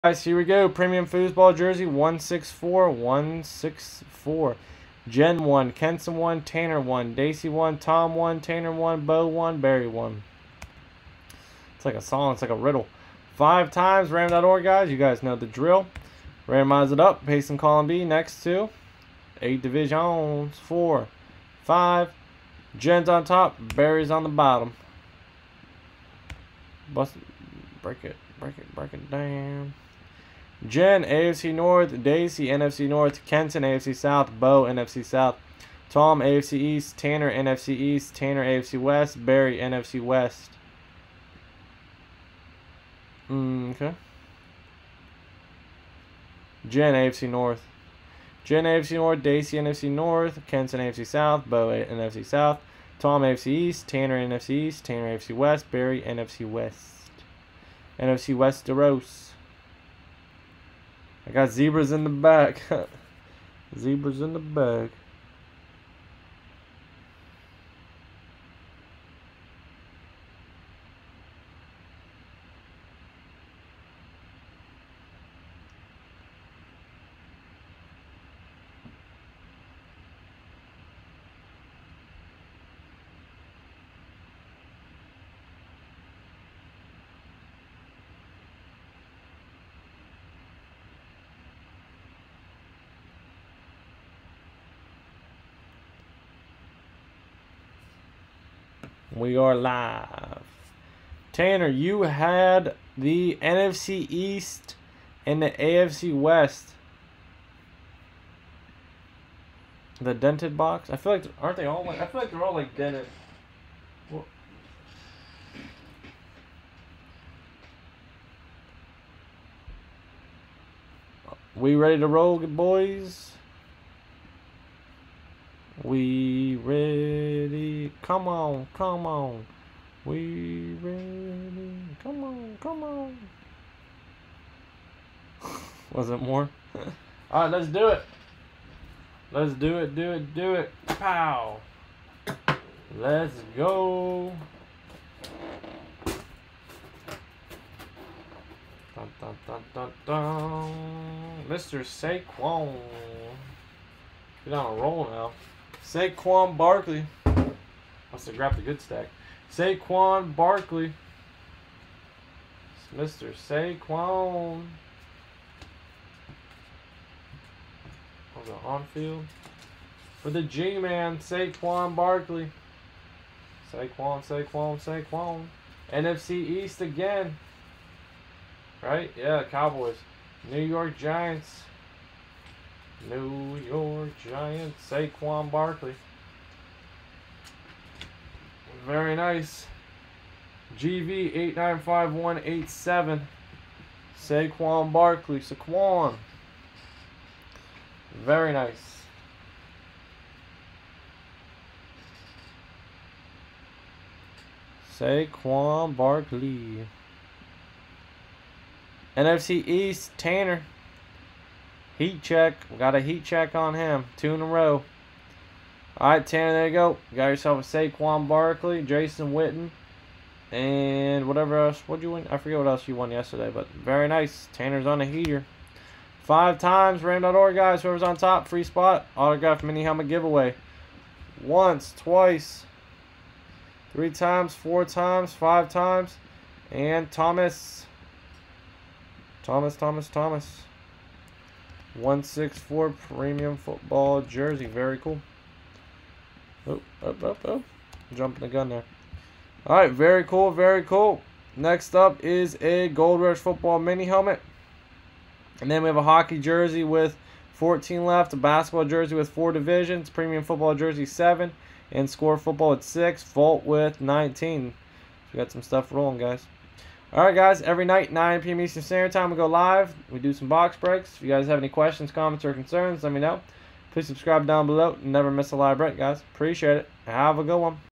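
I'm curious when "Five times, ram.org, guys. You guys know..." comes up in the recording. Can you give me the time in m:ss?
0:13.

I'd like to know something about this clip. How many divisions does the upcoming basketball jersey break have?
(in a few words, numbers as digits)
4.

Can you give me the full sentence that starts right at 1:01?
I got zebras in the back.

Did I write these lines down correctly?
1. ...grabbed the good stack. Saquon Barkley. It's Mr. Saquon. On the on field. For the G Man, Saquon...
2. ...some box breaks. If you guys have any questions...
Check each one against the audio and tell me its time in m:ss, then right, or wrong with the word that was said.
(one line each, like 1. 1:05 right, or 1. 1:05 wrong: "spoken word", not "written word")
1. 2:38 right
2. 4:30 right.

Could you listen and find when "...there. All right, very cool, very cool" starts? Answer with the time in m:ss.
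4:08.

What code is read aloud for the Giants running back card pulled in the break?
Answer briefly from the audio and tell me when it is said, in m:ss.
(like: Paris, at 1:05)
GV895187, at 3:10.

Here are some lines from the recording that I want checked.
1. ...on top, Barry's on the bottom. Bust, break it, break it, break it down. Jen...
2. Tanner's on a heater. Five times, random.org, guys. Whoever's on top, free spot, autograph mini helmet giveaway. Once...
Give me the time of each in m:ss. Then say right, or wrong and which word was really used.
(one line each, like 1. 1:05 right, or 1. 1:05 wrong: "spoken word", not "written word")
1. 0:23 right
2. 3:44 right.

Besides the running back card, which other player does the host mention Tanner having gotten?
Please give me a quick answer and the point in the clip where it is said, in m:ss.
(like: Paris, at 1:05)
Jason Witten, at 3:38.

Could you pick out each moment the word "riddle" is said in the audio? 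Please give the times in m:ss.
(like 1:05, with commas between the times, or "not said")
0:12.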